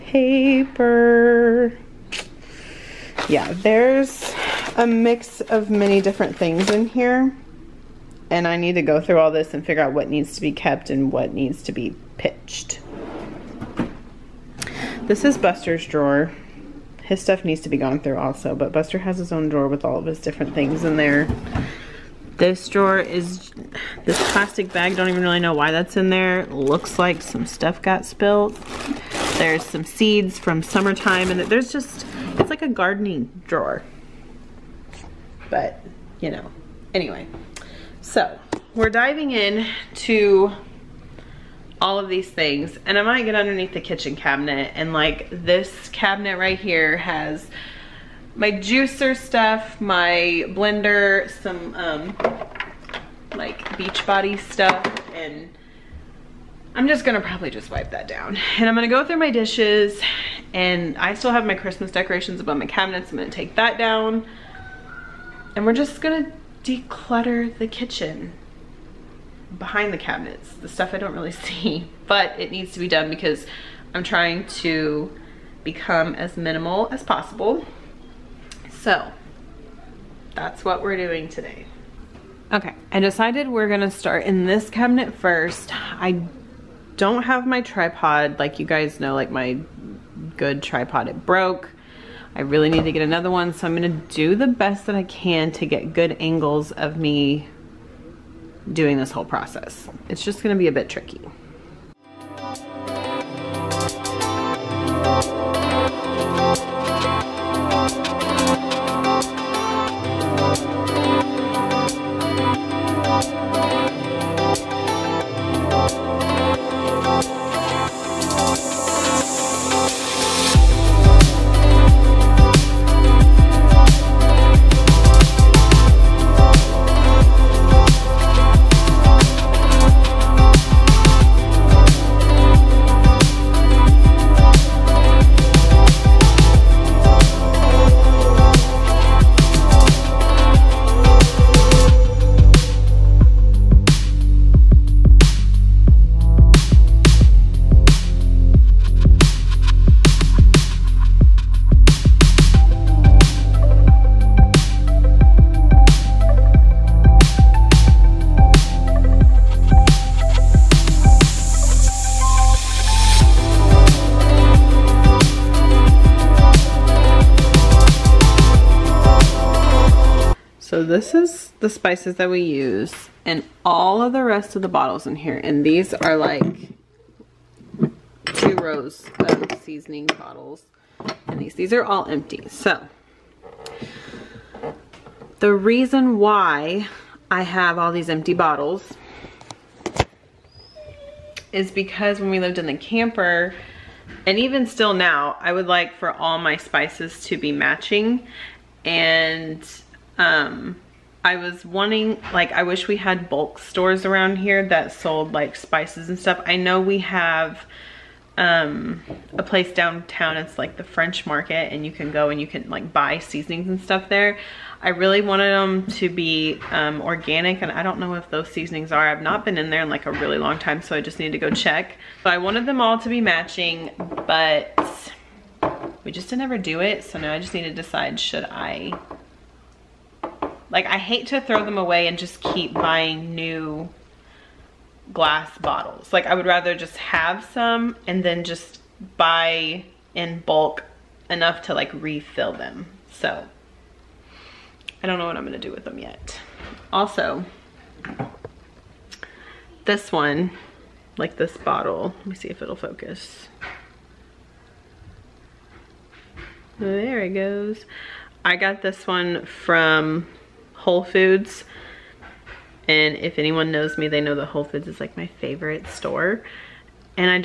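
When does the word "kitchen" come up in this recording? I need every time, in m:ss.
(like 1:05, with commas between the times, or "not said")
0:43, 1:07.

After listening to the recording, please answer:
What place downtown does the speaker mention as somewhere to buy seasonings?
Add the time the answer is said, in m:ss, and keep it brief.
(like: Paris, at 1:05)
The French market, at 3:30.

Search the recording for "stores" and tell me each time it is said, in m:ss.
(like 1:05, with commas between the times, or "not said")
3:23, 4:25.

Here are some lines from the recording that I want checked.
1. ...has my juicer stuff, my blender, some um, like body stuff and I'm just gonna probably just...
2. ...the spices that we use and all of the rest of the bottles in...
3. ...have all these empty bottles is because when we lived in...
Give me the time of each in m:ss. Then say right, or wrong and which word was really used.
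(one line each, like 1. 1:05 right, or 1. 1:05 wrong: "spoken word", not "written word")
1. 0:46 right
2. 2:51 right
3. 3:07 right.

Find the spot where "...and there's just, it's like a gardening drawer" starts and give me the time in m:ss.
0:31.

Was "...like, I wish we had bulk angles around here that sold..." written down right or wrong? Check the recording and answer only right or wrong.
wrong.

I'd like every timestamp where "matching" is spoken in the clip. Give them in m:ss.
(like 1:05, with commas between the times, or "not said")
3:17, 3:43.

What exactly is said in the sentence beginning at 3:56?
Like I would rather just have some and then just buy in bulk enough to like refill them.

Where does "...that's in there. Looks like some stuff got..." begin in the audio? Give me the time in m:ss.
0:25.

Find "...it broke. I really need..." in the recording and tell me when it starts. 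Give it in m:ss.
1:31.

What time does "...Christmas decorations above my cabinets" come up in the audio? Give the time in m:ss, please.
1:01.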